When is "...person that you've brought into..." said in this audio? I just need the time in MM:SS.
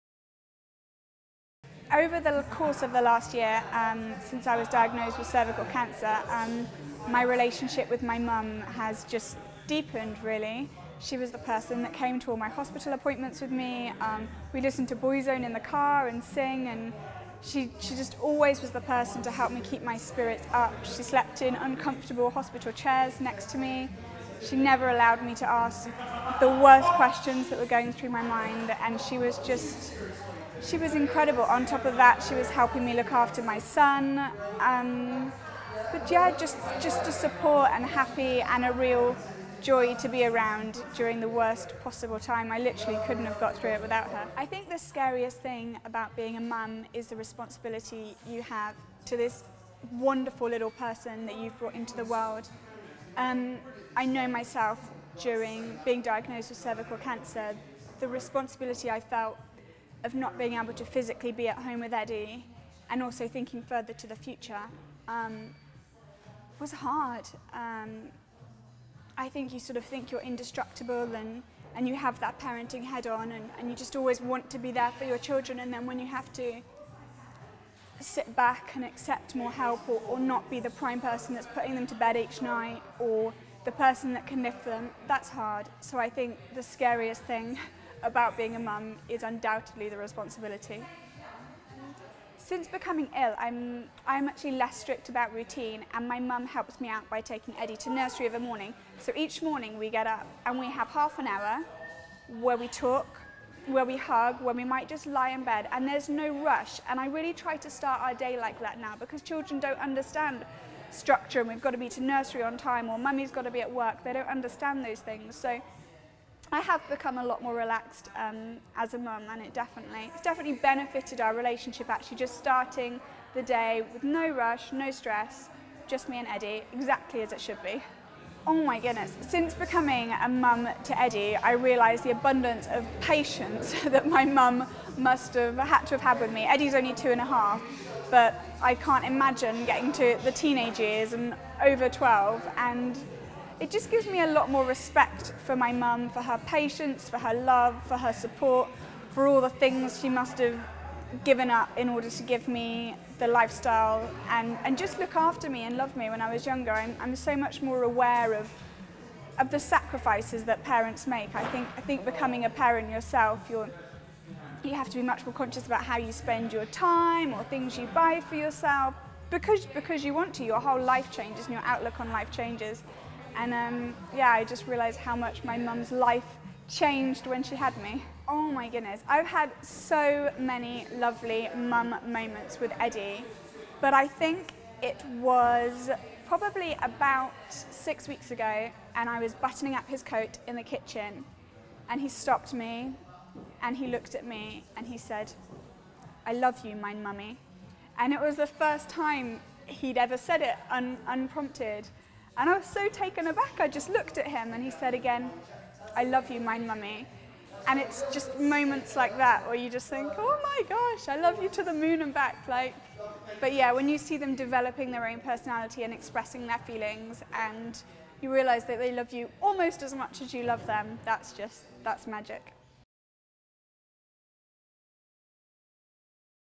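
00:50.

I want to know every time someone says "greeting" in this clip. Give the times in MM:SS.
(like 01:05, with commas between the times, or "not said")
not said.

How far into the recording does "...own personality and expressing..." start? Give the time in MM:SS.
03:35.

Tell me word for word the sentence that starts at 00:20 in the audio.
She slept in uncomfortable hospital chairs next to me.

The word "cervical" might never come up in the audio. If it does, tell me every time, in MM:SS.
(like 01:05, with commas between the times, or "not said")
00:05, 00:56.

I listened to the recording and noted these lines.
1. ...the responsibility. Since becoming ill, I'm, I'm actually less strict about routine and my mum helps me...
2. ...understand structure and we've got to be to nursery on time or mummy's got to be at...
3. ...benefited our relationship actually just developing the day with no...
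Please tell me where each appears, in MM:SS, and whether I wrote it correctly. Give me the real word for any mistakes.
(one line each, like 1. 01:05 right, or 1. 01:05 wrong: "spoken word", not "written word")
1. 01:29 right
2. 01:49 right
3. 02:00 wrong: "starting", not "developing".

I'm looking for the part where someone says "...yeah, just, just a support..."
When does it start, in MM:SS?
00:36.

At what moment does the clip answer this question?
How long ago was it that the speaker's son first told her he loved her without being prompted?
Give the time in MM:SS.
03:07.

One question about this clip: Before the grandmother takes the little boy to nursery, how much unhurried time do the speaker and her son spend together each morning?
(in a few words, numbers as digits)
half an hour.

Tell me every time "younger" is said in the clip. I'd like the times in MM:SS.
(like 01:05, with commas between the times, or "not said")
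02:36.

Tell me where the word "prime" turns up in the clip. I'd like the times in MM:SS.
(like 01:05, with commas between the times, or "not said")
01:20.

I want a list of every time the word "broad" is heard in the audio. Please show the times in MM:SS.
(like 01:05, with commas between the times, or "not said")
not said.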